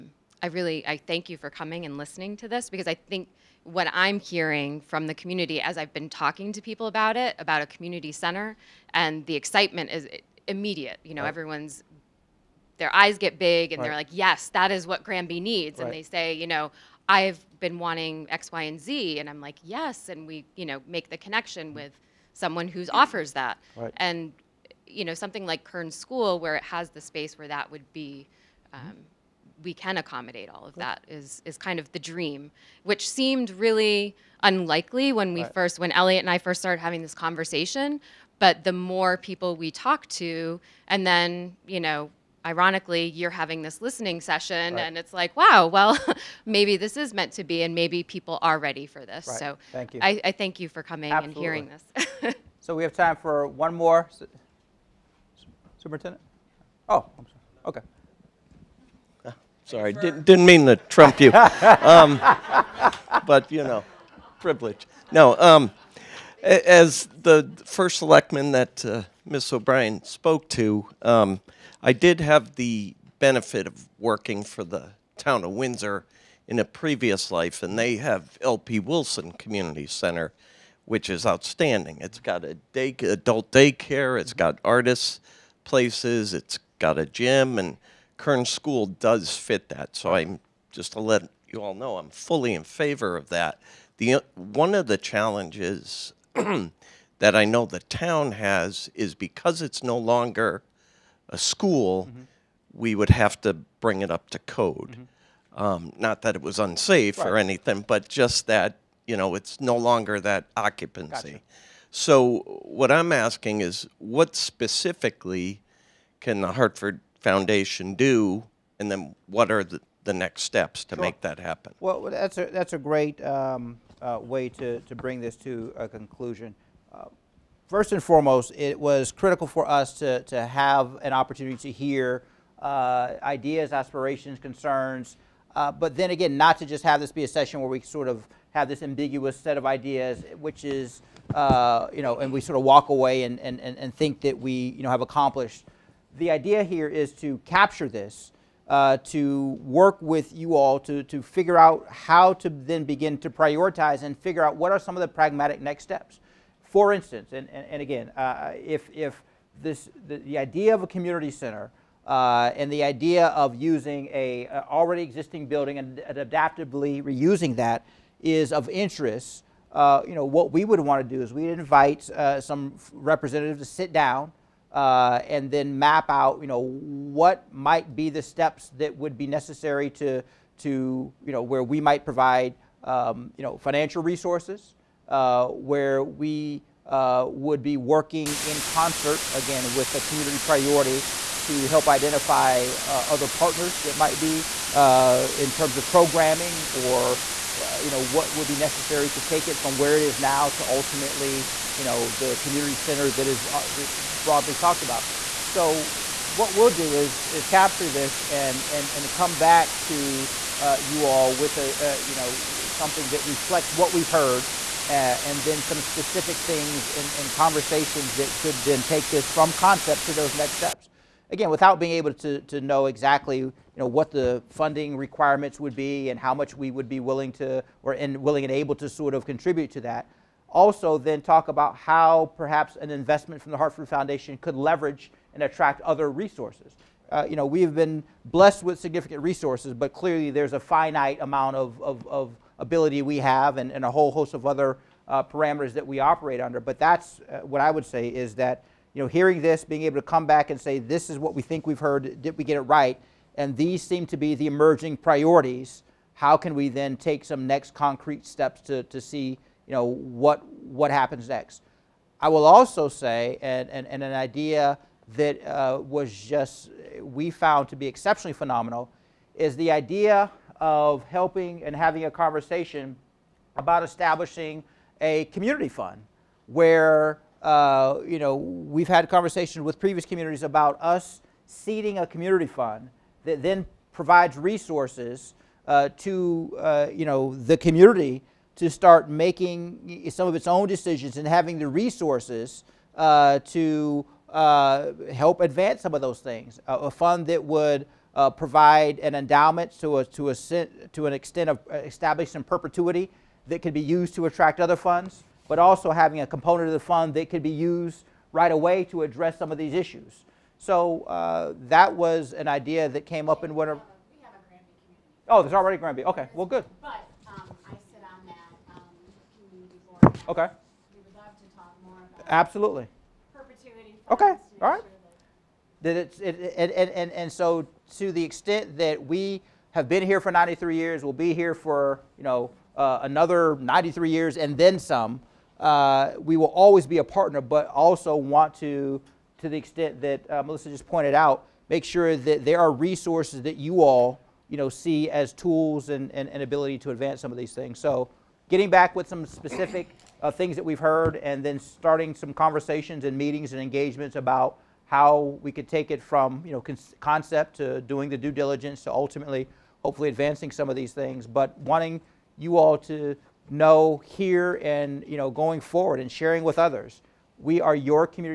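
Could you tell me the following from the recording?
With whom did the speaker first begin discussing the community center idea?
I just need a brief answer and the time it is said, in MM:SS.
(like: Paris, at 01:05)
Elliot, at 00:35.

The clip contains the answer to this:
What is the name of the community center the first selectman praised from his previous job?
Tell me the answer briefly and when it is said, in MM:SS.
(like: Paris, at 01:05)
LP Wilson Community Center, at 01:18.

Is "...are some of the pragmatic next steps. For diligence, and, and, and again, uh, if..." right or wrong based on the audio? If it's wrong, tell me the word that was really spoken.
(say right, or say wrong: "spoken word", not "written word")
wrong: "instance", not "diligence".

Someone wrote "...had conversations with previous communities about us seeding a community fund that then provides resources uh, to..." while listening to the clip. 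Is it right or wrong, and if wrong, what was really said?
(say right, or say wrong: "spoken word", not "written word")
right.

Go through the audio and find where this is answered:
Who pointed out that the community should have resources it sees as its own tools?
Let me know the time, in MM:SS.
05:40.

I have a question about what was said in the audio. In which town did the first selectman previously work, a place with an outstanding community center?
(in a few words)
Windsor.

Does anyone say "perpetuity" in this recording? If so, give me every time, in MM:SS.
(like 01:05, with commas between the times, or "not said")
05:02, 05:23.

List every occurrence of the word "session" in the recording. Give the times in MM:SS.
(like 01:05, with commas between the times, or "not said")
00:44, 02:17.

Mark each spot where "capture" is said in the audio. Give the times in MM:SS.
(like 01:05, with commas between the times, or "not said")
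02:27, 03:27.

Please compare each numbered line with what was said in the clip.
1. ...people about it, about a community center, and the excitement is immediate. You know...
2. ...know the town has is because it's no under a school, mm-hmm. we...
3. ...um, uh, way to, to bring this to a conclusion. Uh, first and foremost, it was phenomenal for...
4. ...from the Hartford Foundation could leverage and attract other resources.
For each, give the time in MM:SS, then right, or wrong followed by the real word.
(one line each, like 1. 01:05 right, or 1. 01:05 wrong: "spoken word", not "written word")
1. 00:06 right
2. 01:37 wrong: "longer", not "under"
3. 02:03 wrong: "critical", not "phenomenal"
4. 03:53 right.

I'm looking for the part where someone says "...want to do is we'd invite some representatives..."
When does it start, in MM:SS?
02:50.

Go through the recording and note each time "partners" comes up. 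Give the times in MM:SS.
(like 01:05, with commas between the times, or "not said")
03:13, 05:37.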